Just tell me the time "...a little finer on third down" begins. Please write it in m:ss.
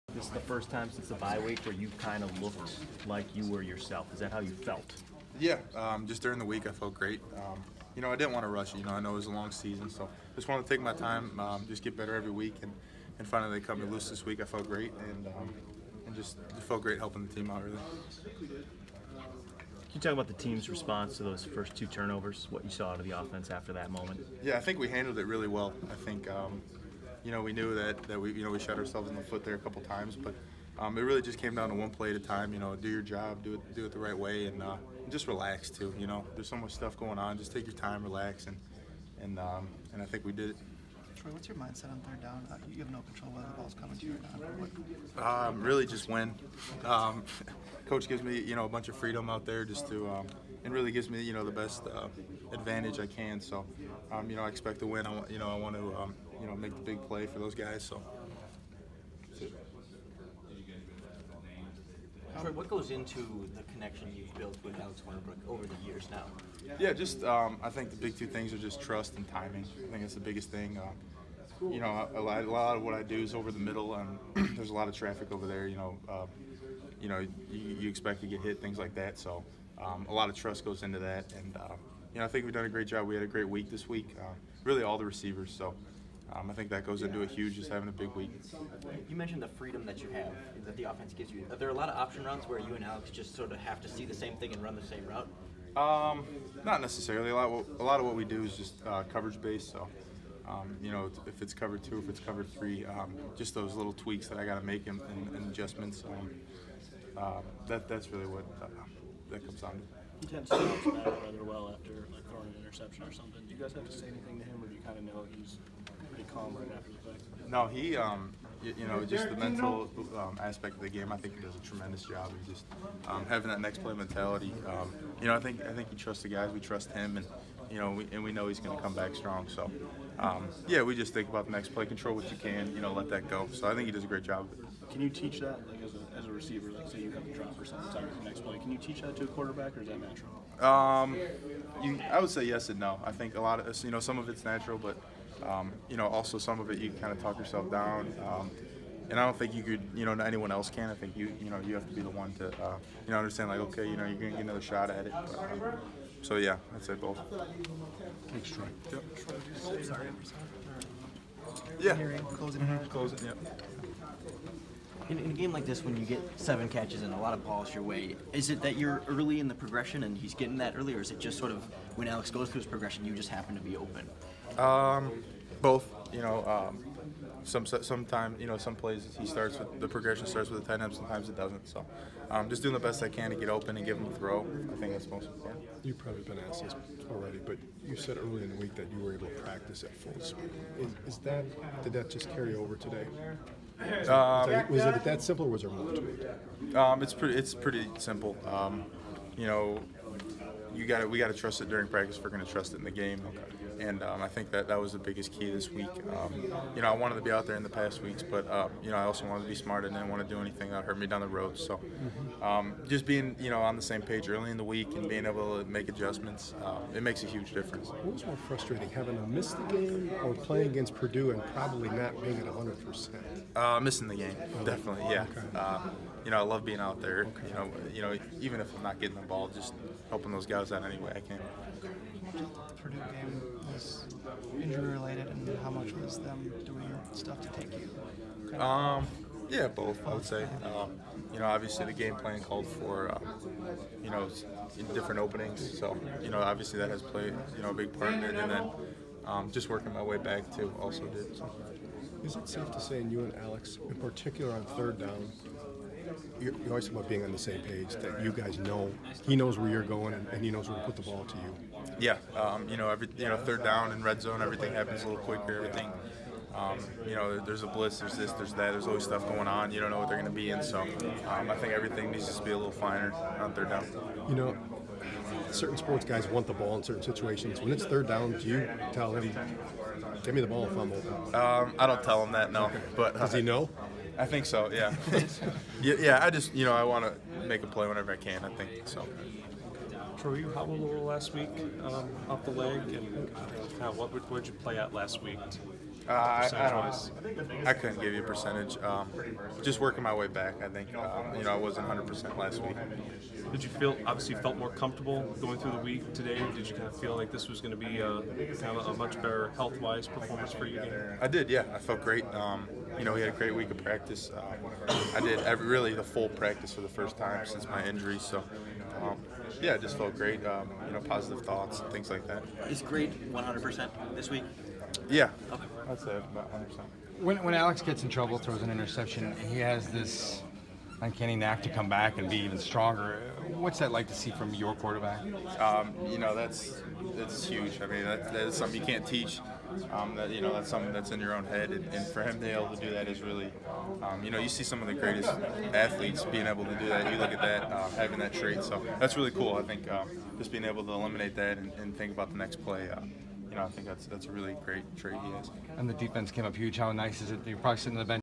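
4:32.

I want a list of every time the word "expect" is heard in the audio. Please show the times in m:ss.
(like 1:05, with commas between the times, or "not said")
0:54, 1:17.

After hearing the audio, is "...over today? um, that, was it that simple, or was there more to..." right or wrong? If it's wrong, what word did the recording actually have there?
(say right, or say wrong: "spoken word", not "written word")
right.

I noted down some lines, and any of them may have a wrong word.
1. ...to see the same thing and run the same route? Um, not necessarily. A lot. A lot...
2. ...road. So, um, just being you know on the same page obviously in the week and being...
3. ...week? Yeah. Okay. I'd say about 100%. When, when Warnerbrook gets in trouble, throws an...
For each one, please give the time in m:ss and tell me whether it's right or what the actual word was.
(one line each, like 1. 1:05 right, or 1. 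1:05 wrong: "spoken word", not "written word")
1. 1:33 right
2. 3:31 wrong: "early", not "obviously"
3. 5:24 wrong: "Alex", not "Warnerbrook".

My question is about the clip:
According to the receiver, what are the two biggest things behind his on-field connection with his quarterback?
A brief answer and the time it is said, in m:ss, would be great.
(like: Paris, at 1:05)
Trust and timing, at 1:08.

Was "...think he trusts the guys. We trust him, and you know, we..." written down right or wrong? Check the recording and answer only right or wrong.
right.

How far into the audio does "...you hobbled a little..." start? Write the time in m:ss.
4:50.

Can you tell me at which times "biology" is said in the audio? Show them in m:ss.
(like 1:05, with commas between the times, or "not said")
not said.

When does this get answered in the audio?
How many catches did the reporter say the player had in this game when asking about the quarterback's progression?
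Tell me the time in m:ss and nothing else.
2:46.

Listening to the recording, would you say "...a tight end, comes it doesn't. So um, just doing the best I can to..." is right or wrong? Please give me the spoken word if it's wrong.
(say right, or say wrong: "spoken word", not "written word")
wrong: "sometimes", not "comes".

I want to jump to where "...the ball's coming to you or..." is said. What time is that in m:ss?
0:43.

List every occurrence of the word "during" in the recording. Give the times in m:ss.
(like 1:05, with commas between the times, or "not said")
0:06, 3:21.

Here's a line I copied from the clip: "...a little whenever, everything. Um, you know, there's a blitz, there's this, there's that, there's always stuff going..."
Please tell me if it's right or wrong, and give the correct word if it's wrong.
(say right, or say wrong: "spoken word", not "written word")
wrong: "quicker", not "whenever".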